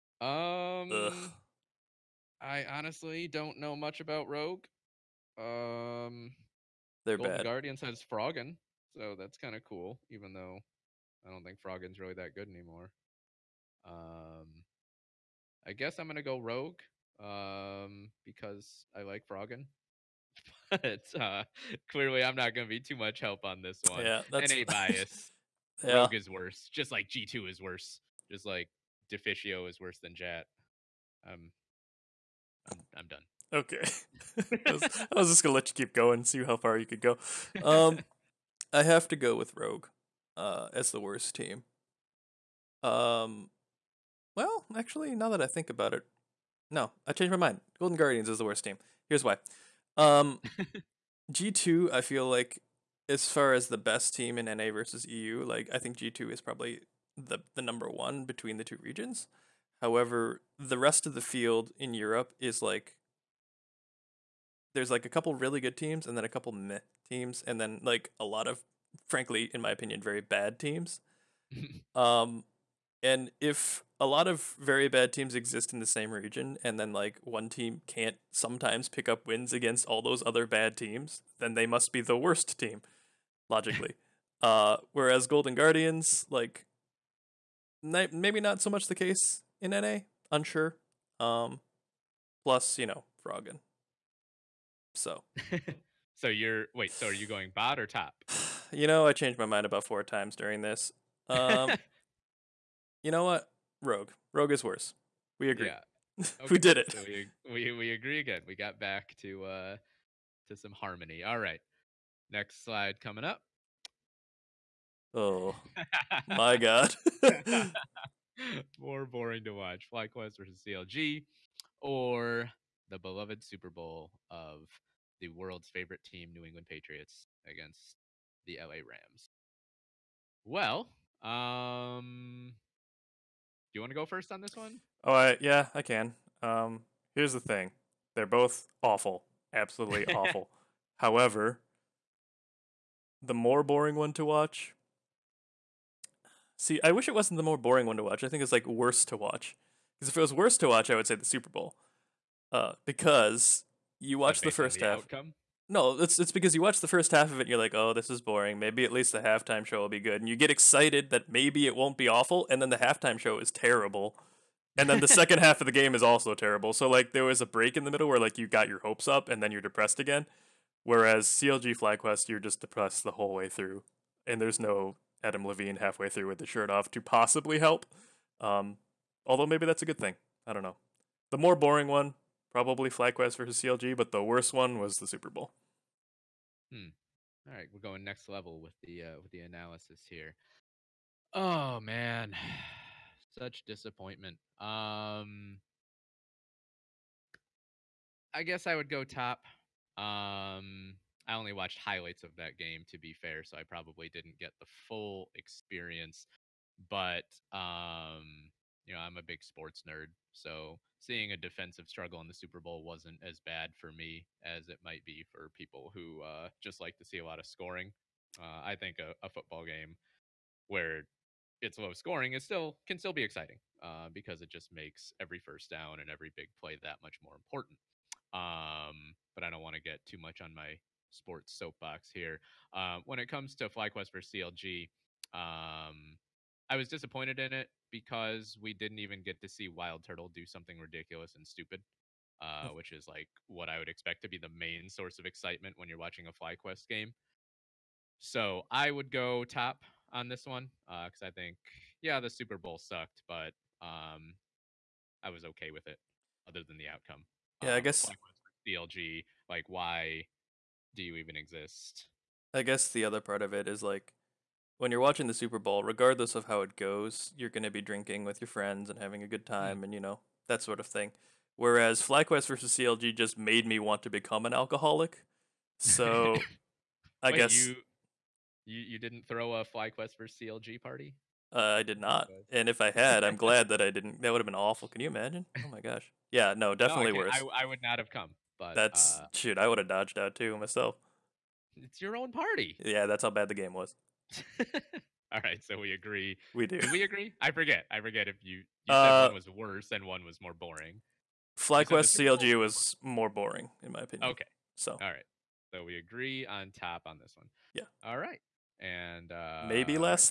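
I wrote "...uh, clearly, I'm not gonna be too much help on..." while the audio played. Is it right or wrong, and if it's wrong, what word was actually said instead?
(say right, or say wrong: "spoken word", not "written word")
right.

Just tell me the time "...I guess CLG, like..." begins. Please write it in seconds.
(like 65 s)
257 s.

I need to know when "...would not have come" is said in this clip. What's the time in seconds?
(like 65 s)
287 s.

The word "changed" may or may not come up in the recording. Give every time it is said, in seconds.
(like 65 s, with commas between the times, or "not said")
47 s, 99 s.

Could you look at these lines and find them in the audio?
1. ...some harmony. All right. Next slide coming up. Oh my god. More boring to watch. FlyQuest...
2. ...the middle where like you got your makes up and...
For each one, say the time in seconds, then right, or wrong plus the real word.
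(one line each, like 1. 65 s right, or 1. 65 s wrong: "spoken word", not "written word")
1. 110 s right
2. 167 s wrong: "hopes", not "makes".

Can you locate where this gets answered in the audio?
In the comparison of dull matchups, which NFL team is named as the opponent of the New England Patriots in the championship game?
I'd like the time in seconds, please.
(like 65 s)
128 s.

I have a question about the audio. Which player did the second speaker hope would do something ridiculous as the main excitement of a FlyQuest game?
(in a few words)
Wild Turtle.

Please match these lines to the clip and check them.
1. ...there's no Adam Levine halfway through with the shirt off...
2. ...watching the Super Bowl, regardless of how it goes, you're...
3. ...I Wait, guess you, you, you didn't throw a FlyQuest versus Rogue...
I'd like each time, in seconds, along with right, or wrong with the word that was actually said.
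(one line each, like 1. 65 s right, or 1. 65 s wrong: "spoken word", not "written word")
1. 174 s right
2. 265 s right
3. 277 s wrong: "CLG", not "Rogue".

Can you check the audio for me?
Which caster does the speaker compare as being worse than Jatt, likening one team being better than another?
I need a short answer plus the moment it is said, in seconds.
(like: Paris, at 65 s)
Deficio, at 29 s.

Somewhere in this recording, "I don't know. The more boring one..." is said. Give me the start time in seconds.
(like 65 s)
180 s.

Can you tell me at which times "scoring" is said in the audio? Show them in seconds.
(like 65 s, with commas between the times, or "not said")
217 s, 221 s.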